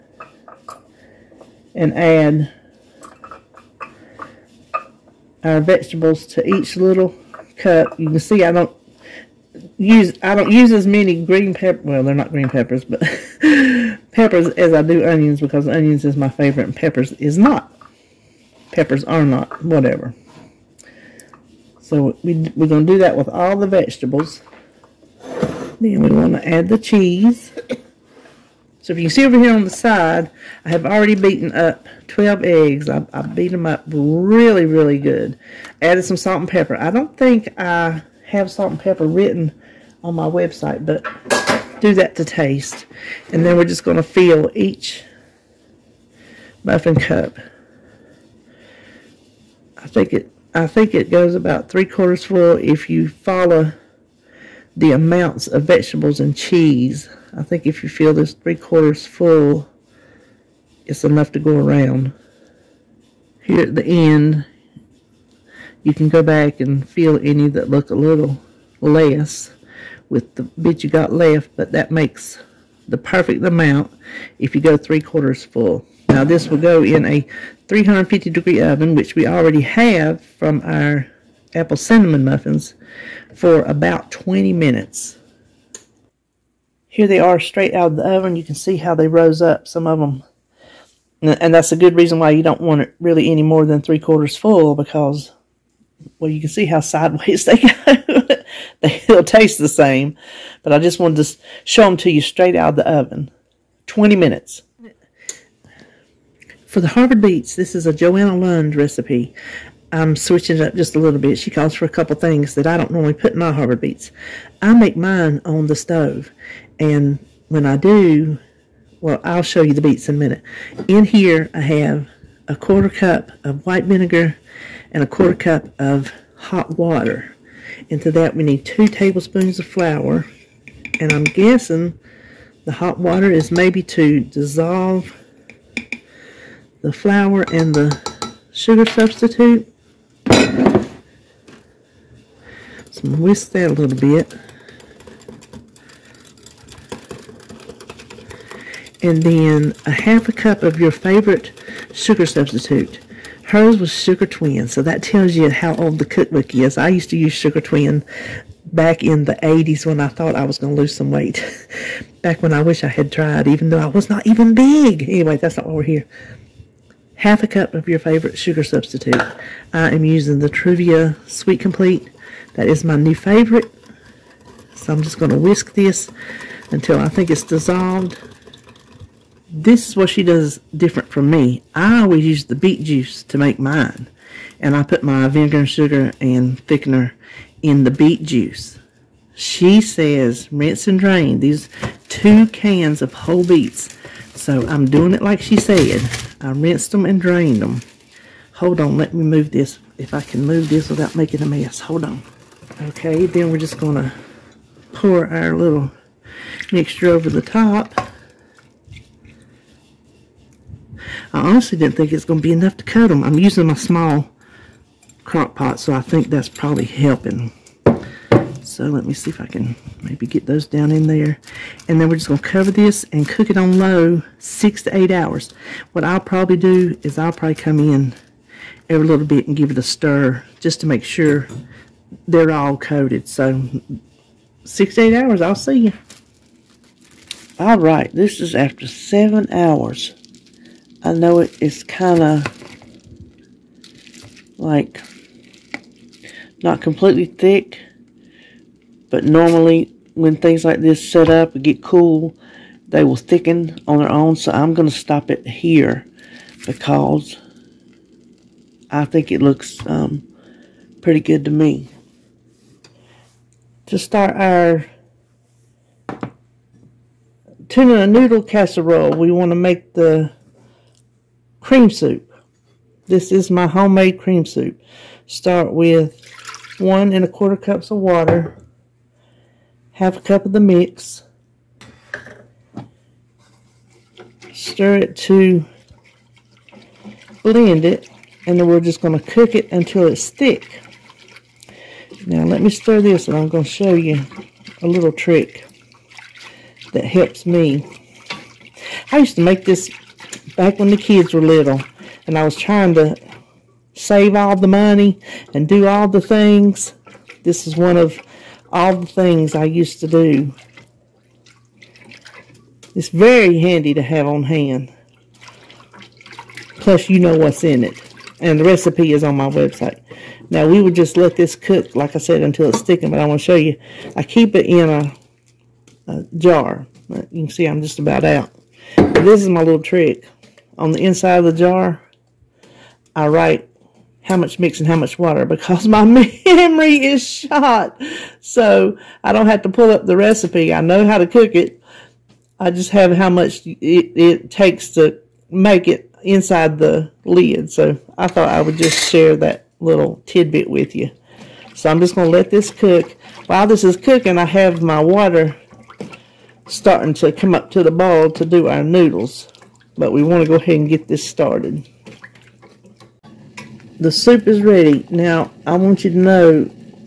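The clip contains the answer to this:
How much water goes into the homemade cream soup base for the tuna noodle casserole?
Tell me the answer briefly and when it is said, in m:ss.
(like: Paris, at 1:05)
1 1/4 cups, at 4:36.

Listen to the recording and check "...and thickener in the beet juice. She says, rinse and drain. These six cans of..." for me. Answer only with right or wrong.
wrong.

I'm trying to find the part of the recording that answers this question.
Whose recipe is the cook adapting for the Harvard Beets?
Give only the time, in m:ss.
1:47.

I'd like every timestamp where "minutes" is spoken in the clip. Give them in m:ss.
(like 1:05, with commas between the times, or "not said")
1:24, 1:44, 2:00.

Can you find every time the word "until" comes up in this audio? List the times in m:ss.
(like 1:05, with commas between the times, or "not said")
2:56, 4:49, 5:22.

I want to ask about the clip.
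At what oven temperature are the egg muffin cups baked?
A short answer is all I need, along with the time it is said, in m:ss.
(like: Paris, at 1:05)
350 degrees, at 1:17.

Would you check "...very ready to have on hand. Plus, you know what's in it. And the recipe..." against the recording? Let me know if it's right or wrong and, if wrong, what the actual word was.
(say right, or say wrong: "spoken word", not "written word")
wrong: "handy", not "ready".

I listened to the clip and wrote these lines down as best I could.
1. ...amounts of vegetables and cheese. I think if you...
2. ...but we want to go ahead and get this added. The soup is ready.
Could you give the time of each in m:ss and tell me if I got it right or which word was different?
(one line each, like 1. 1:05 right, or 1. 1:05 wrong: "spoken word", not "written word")
1. 0:54 right
2. 5:59 wrong: "started", not "added".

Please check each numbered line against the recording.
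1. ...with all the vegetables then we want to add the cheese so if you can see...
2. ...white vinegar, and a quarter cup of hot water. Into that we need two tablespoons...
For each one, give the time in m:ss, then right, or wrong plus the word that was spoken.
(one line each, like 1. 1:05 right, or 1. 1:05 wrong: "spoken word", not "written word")
1. 0:23 right
2. 2:03 right.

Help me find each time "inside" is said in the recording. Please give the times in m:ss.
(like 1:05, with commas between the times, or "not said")
5:31, 5:46.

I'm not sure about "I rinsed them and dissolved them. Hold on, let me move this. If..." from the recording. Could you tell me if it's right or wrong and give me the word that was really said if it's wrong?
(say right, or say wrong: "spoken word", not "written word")
wrong: "drained", not "dissolved".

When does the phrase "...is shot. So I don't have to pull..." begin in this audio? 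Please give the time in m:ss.
5:37.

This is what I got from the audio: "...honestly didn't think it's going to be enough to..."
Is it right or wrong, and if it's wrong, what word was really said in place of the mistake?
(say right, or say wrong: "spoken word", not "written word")
right.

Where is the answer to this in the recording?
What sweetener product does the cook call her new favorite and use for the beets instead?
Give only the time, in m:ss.
2:50.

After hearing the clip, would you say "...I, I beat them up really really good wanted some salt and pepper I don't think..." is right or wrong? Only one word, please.
wrong.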